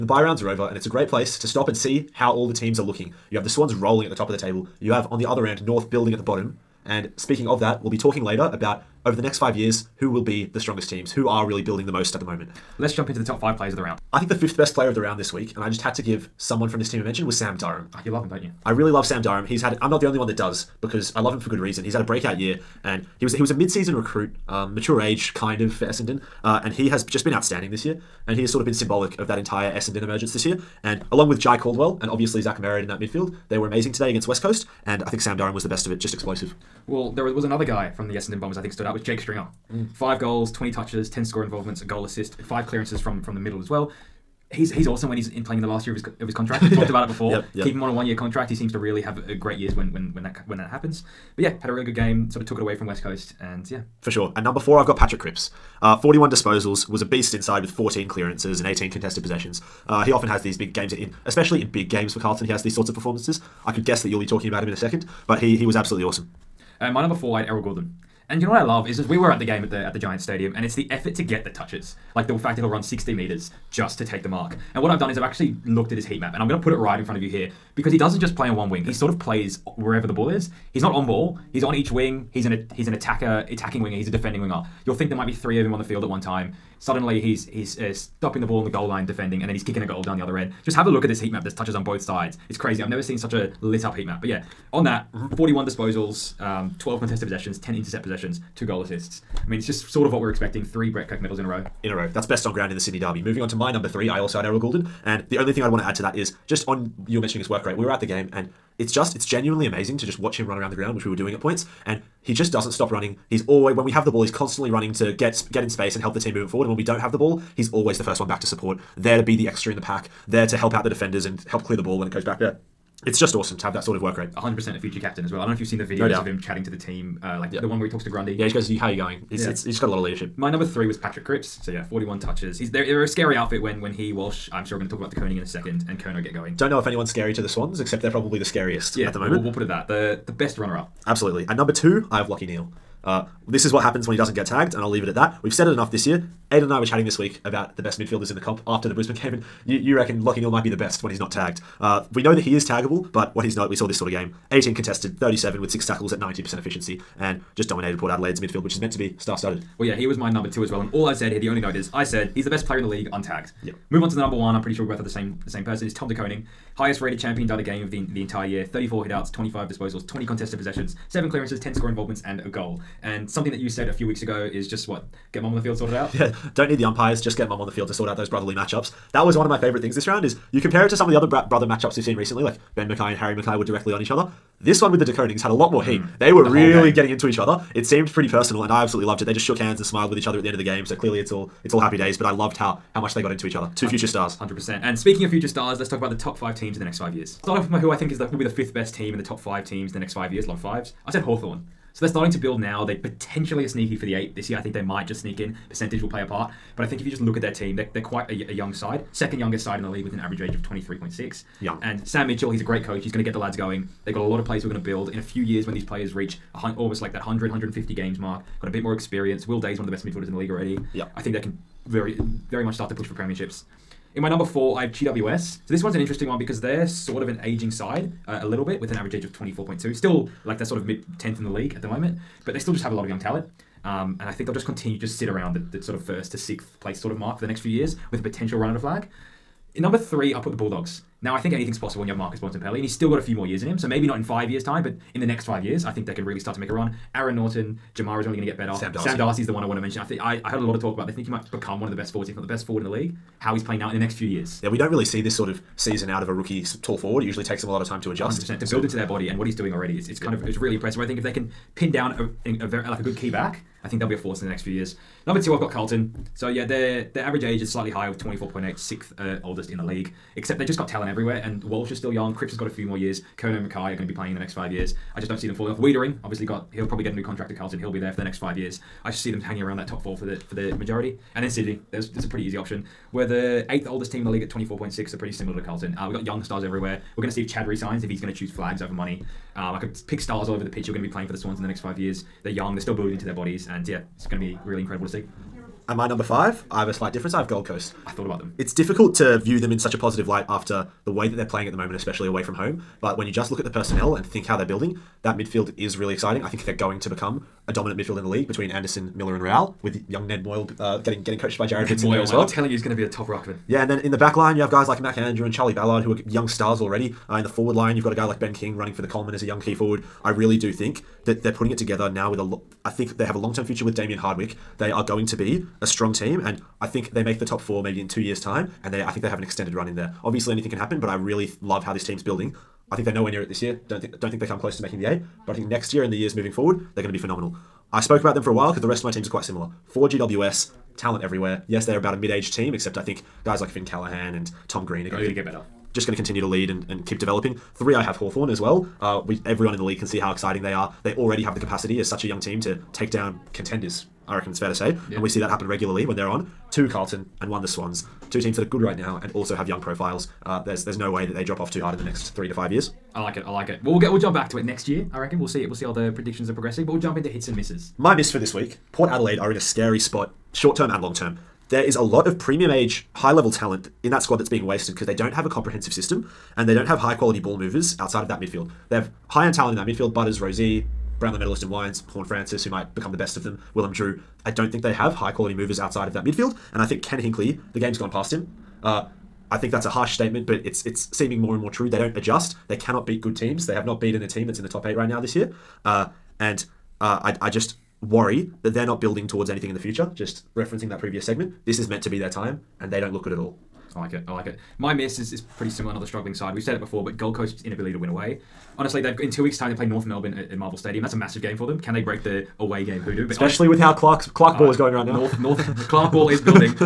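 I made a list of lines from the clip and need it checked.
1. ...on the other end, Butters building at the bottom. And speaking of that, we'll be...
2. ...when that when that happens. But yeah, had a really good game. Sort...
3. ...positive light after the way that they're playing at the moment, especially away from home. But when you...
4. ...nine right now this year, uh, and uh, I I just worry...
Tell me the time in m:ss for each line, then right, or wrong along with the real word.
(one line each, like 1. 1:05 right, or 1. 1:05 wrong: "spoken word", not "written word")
1. 0:05 wrong: "North", not "Butters"
2. 0:50 right
3. 4:59 right
4. 6:34 wrong: "eight", not "nine".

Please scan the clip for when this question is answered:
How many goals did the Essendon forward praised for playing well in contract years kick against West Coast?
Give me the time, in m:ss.
0:39.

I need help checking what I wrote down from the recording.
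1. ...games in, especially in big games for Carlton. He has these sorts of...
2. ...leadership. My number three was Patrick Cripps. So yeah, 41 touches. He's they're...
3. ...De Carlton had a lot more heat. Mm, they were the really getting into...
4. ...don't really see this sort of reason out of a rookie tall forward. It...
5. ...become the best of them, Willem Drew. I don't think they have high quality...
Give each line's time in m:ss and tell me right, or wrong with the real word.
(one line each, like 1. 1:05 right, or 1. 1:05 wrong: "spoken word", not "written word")
1. 1:00 right
2. 2:10 right
3. 3:05 wrong: "Konings", not "Carlton"
4. 4:14 wrong: "season", not "reason"
5. 6:22 right.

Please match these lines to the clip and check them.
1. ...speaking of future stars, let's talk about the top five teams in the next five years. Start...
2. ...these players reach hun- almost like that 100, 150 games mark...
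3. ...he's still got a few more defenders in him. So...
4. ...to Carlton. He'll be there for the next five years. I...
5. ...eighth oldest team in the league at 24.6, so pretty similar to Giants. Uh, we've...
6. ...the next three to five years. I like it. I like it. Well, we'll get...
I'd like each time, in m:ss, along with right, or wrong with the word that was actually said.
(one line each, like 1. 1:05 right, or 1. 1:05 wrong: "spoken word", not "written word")
1. 3:14 right
2. 3:35 right
3. 4:02 wrong: "years", not "defenders"
4. 4:37 right
5. 4:43 wrong: "Carlton", not "Giants"
6. 6:01 right.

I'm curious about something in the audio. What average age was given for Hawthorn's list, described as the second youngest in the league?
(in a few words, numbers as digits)
23.6.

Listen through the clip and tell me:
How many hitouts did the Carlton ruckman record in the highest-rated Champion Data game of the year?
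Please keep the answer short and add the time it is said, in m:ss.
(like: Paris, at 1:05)
34, at 2:48.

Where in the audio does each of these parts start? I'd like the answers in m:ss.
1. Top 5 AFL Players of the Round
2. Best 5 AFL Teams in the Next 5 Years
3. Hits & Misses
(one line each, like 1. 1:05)
1. 0:13
2. 3:16
3. 6:07.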